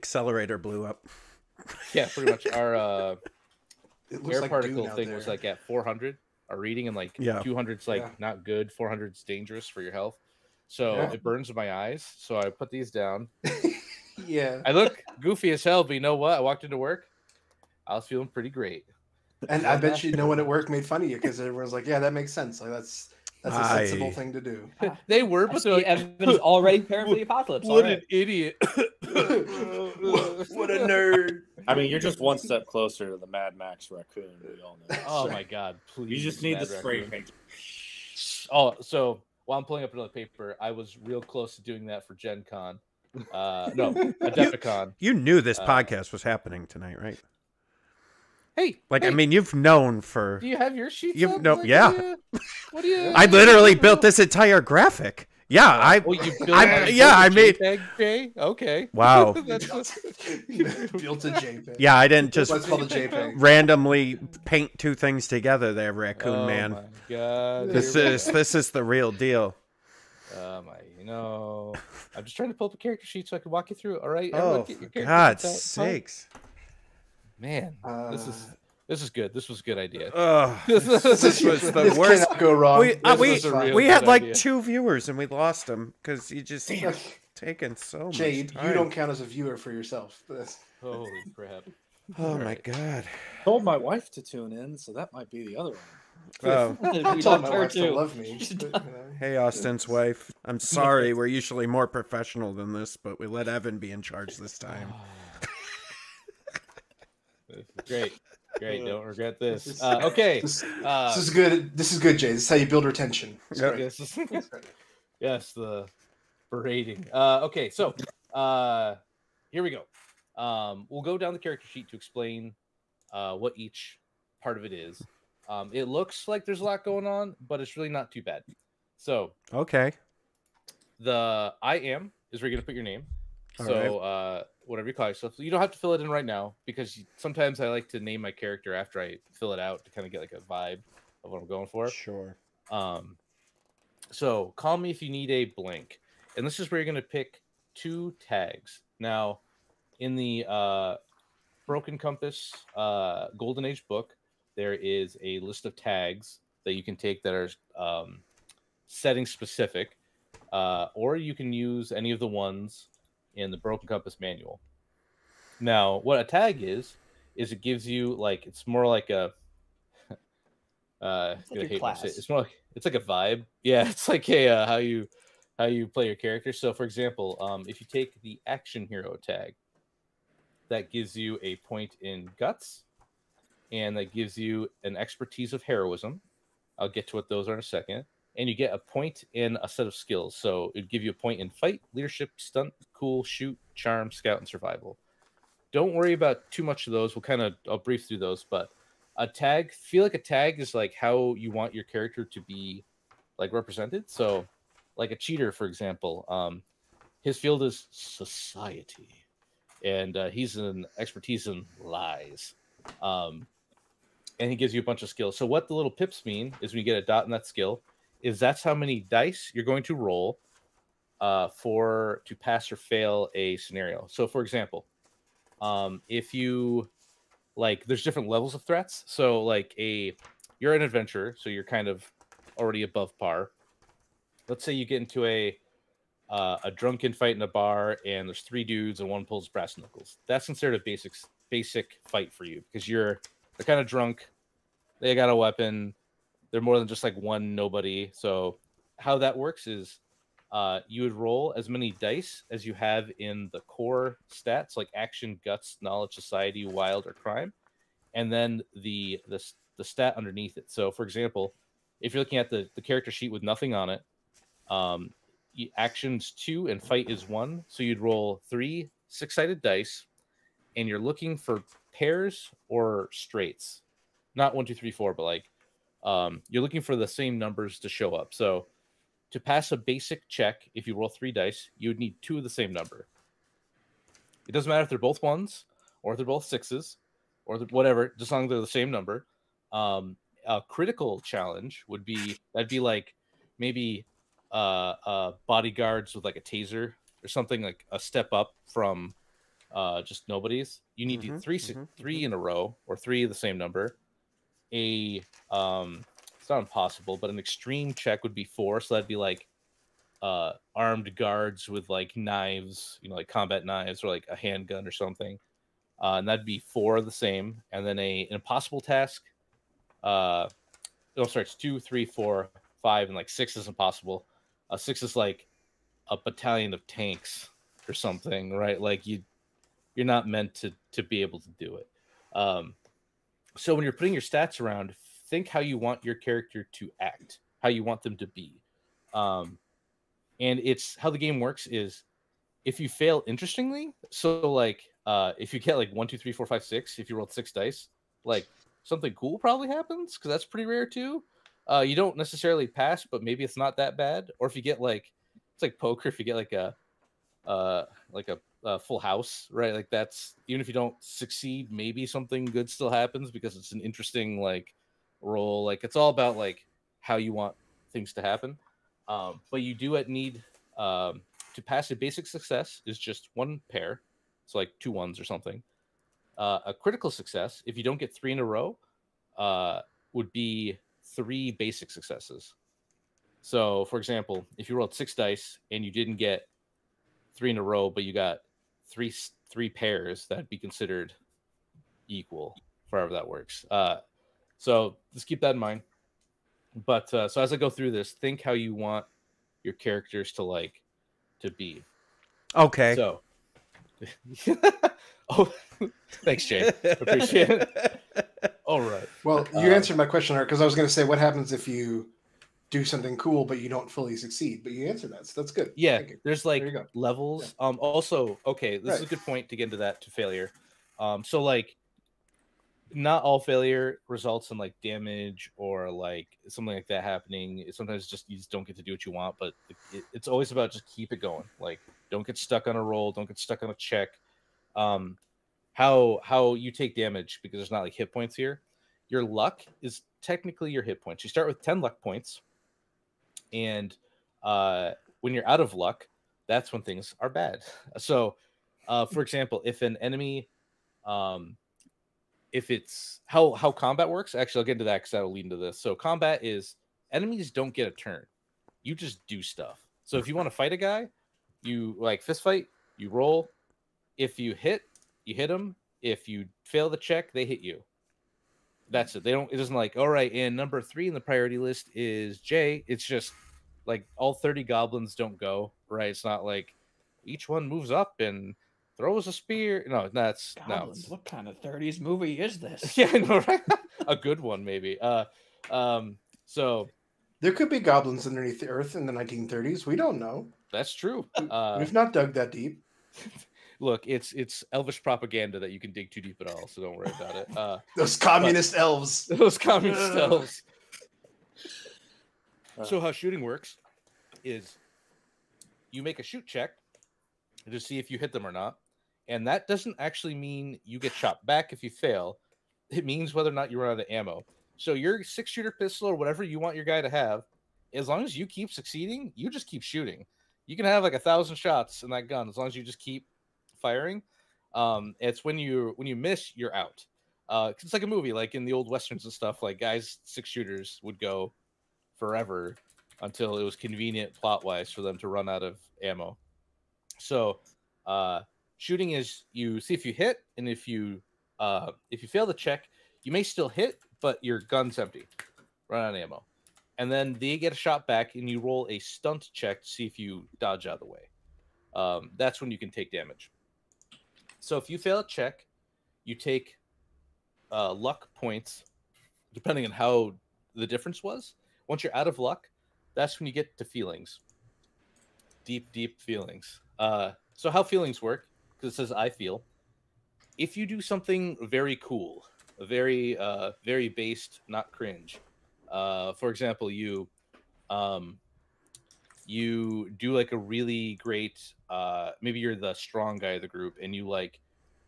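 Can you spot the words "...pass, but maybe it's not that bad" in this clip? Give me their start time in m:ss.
5:52.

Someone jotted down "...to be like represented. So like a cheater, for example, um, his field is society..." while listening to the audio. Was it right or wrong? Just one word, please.
right.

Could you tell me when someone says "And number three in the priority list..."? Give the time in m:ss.
7:50.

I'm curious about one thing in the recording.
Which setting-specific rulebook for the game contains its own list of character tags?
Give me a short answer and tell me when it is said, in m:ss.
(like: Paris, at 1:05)
Golden Age, at 2:33.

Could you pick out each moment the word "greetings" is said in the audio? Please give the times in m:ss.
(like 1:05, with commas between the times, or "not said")
not said.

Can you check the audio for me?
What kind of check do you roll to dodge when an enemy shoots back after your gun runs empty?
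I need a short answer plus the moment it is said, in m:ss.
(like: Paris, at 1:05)
Stunt check, at 9:08.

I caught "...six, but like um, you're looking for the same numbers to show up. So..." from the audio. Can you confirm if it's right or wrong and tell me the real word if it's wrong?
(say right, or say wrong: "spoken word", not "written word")
wrong: "four", not "six".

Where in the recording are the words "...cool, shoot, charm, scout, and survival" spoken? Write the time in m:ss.
3:12.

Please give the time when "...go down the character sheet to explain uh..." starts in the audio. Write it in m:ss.
2:01.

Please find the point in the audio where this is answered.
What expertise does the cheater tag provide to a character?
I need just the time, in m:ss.
3:31.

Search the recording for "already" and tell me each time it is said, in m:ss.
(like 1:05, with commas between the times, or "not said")
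0:26, 3:52.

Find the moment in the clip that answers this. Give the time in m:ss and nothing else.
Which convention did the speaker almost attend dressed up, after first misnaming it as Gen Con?
0:43.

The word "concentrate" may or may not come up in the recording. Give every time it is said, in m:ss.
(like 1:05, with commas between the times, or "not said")
not said.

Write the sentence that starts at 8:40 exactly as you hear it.
You can have like a thousand shots in that gun as long as you just keep firing.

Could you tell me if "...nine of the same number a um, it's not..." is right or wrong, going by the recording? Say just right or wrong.
wrong.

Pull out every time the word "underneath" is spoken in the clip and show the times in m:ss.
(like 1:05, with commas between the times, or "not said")
4:20, 8:08.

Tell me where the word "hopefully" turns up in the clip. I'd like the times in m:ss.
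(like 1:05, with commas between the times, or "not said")
not said.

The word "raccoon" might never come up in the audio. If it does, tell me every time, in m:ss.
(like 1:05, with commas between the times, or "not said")
0:33, 1:05.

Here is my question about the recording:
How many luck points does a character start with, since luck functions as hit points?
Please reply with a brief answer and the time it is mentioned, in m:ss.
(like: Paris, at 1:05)
10, at 7:21.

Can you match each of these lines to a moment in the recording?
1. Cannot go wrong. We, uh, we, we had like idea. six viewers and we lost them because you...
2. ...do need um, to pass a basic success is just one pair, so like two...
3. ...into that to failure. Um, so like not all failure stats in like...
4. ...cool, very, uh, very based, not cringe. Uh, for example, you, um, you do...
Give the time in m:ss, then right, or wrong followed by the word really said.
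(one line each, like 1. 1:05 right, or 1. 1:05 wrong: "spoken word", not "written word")
1. 1:22 wrong: "two", not "six"
2. 6:09 right
3. 6:59 wrong: "results", not "stats"
4. 9:31 right.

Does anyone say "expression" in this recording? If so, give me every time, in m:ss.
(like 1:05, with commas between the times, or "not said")
not said.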